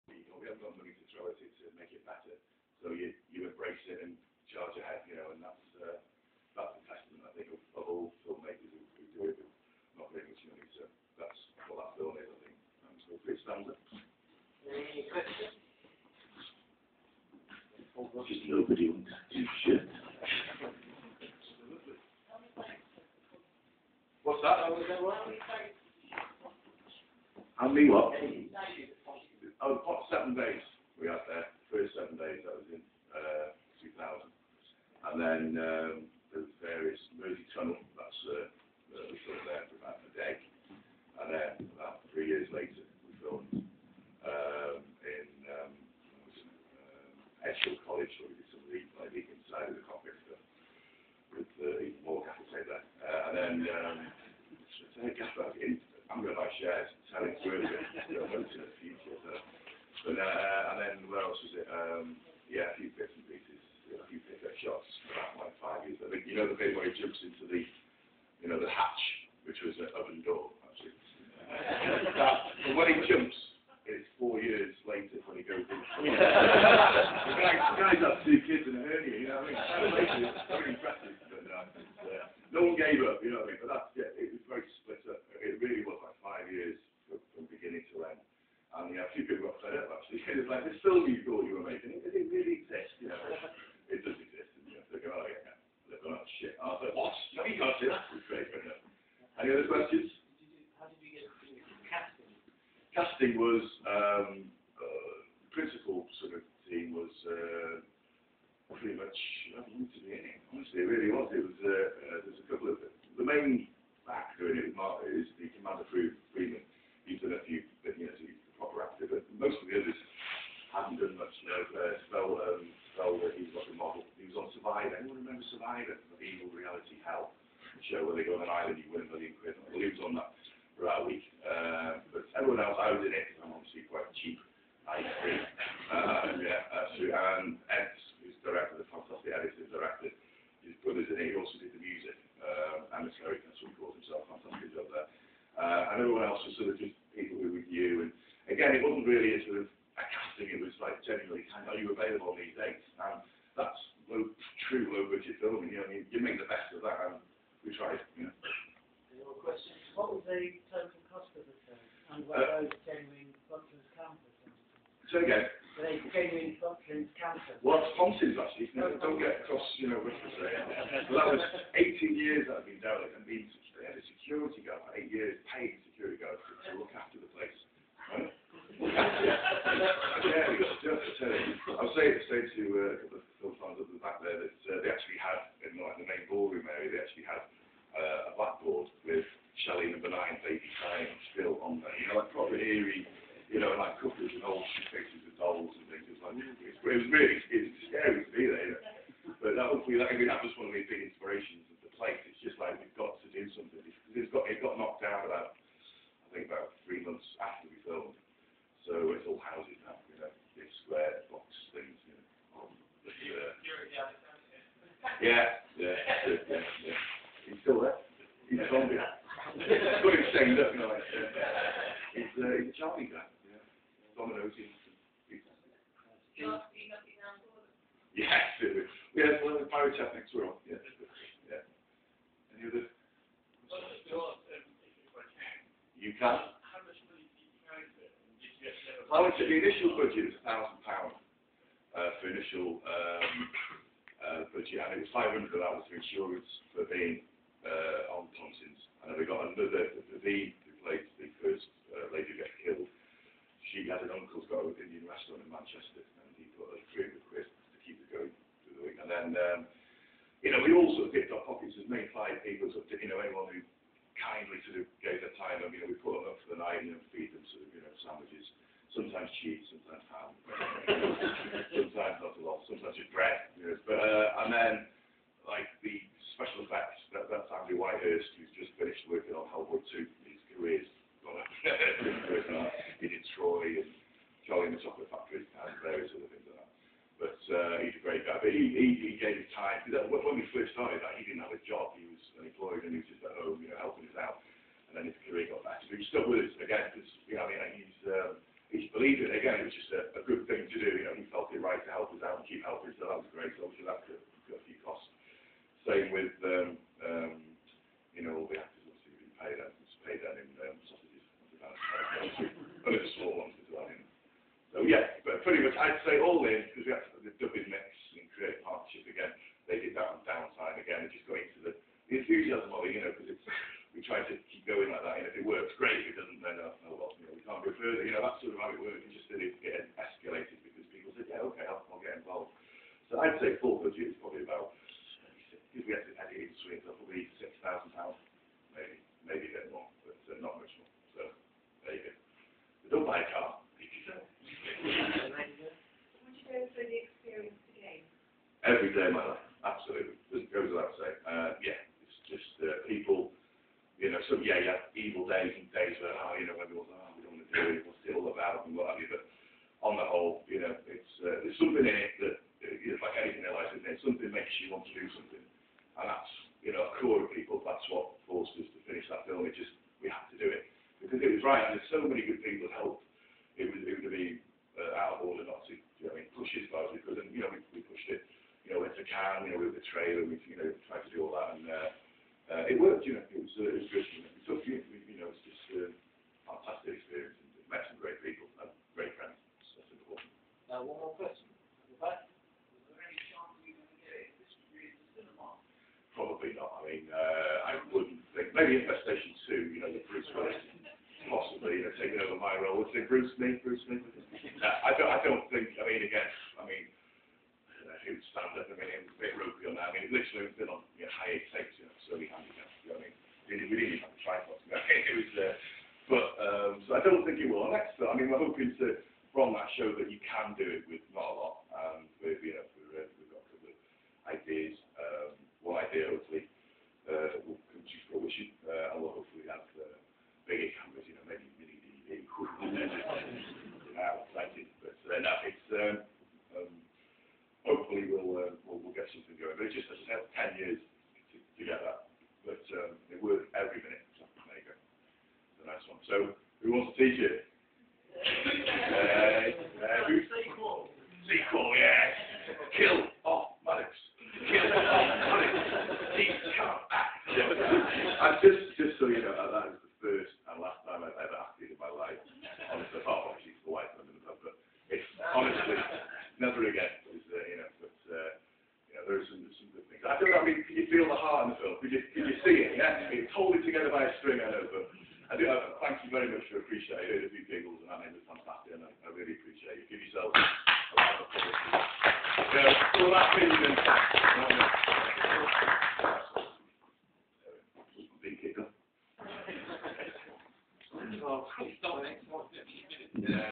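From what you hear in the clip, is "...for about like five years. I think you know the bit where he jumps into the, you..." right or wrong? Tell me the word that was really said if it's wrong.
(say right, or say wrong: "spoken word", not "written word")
right.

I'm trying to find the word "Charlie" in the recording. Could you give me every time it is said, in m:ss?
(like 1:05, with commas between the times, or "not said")
3:42, 4:44.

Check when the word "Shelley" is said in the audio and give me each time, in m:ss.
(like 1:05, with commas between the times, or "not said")
3:09.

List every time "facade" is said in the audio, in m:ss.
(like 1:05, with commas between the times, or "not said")
not said.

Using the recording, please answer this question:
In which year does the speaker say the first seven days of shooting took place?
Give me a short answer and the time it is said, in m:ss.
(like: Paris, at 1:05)
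2000, at 0:33.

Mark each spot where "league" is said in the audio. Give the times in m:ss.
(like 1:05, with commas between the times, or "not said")
0:48.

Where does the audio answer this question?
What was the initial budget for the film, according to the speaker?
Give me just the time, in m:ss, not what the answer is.
4:00.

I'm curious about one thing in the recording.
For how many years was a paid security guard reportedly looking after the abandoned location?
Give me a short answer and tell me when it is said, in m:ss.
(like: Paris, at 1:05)
8, at 2:54.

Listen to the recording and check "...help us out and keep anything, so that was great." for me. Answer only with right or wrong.
wrong.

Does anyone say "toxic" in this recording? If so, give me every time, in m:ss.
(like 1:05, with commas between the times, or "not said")
not said.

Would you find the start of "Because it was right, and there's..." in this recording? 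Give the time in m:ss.
6:11.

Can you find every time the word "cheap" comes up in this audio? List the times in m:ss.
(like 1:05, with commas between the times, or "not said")
2:14, 4:29.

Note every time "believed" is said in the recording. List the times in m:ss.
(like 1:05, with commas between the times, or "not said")
4:58.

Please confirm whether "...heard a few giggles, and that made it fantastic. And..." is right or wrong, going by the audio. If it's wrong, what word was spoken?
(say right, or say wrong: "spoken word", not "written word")
right.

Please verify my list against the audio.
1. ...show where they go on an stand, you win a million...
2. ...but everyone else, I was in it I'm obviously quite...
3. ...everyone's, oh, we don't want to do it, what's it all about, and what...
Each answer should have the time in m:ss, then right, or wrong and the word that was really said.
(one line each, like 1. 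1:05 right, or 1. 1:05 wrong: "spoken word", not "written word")
1. 2:07 wrong: "island", not "stand"
2. 2:12 right
3. 5:56 right.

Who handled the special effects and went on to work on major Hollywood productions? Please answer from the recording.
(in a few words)
Andy Whitehurst.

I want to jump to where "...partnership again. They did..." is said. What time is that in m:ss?
5:18.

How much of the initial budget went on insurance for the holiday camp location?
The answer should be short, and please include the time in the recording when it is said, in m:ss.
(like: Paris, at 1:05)
500, at 4:05.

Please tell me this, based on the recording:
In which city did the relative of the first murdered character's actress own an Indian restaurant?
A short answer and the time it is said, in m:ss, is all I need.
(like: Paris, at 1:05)
Manchester, at 4:15.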